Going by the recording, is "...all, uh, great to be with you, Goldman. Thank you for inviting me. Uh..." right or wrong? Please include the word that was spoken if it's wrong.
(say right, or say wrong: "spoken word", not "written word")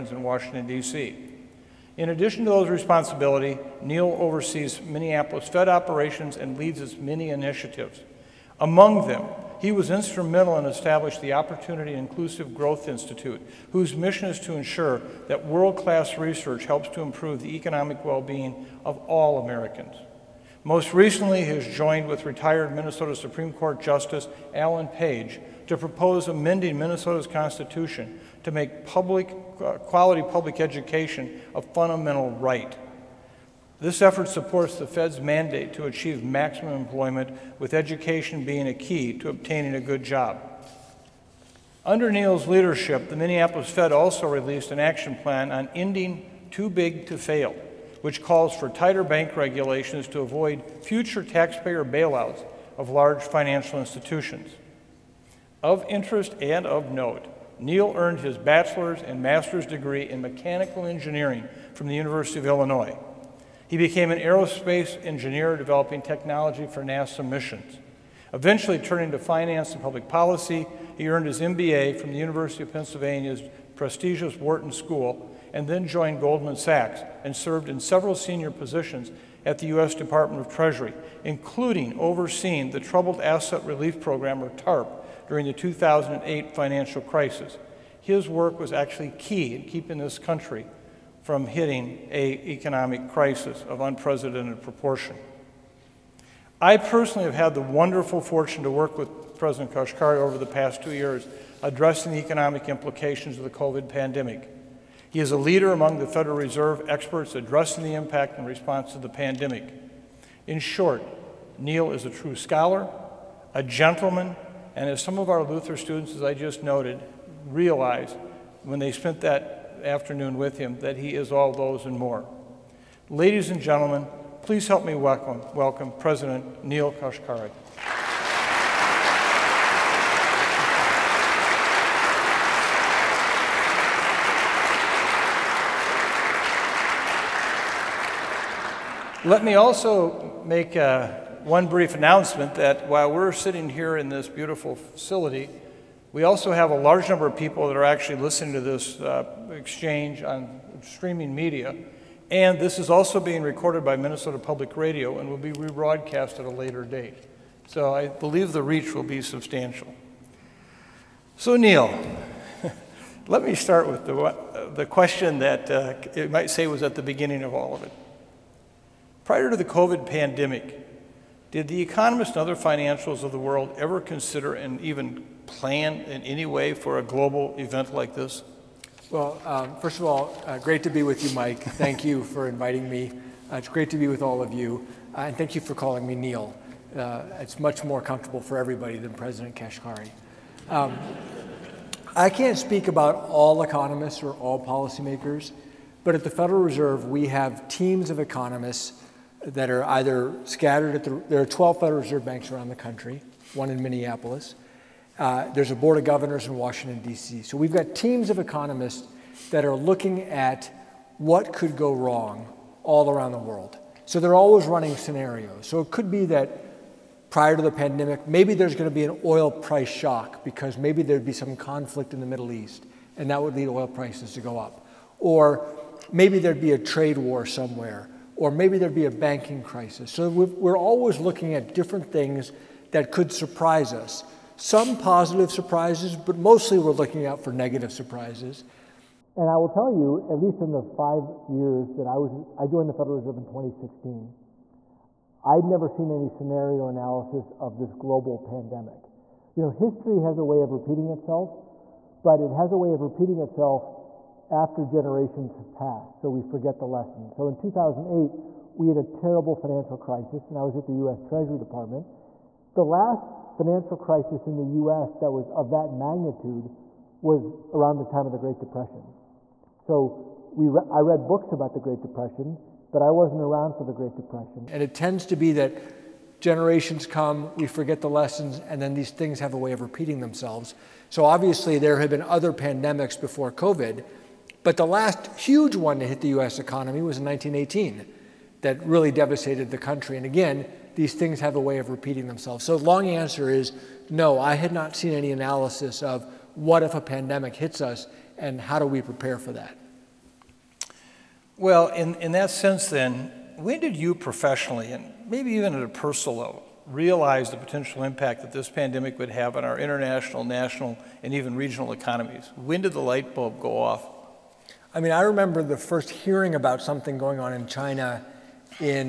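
wrong: "Mike", not "Goldman".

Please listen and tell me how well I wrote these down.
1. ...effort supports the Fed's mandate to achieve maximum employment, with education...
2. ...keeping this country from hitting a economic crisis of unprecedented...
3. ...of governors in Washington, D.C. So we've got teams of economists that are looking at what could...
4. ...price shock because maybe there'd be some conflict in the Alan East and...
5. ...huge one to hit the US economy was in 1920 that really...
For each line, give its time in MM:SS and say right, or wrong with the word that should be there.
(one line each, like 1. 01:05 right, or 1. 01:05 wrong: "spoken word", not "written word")
1. 00:34 right
2. 01:29 right
3. 03:25 right
4. 03:39 wrong: "Middle", not "Alan"
5. 04:45 wrong: "1918", not "1920".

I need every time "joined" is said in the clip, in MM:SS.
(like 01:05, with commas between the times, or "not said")
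00:21, 01:15, 04:02.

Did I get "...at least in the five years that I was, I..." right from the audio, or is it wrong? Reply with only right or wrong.
right.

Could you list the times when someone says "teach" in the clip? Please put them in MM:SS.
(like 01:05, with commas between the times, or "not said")
not said.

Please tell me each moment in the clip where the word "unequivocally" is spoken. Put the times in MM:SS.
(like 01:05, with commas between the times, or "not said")
not said.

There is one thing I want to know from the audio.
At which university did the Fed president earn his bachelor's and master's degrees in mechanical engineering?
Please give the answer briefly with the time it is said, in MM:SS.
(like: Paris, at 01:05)
University of Illinois, at 01:01.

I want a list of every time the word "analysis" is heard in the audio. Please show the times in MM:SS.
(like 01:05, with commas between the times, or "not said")
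04:06, 04:55.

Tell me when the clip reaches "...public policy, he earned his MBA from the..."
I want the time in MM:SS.
01:09.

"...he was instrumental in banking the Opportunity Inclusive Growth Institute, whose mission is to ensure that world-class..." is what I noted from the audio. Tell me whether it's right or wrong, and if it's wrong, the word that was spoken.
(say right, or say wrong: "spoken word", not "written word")
wrong: "establishing", not "banking".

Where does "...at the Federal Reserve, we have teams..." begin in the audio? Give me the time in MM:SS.
03:16.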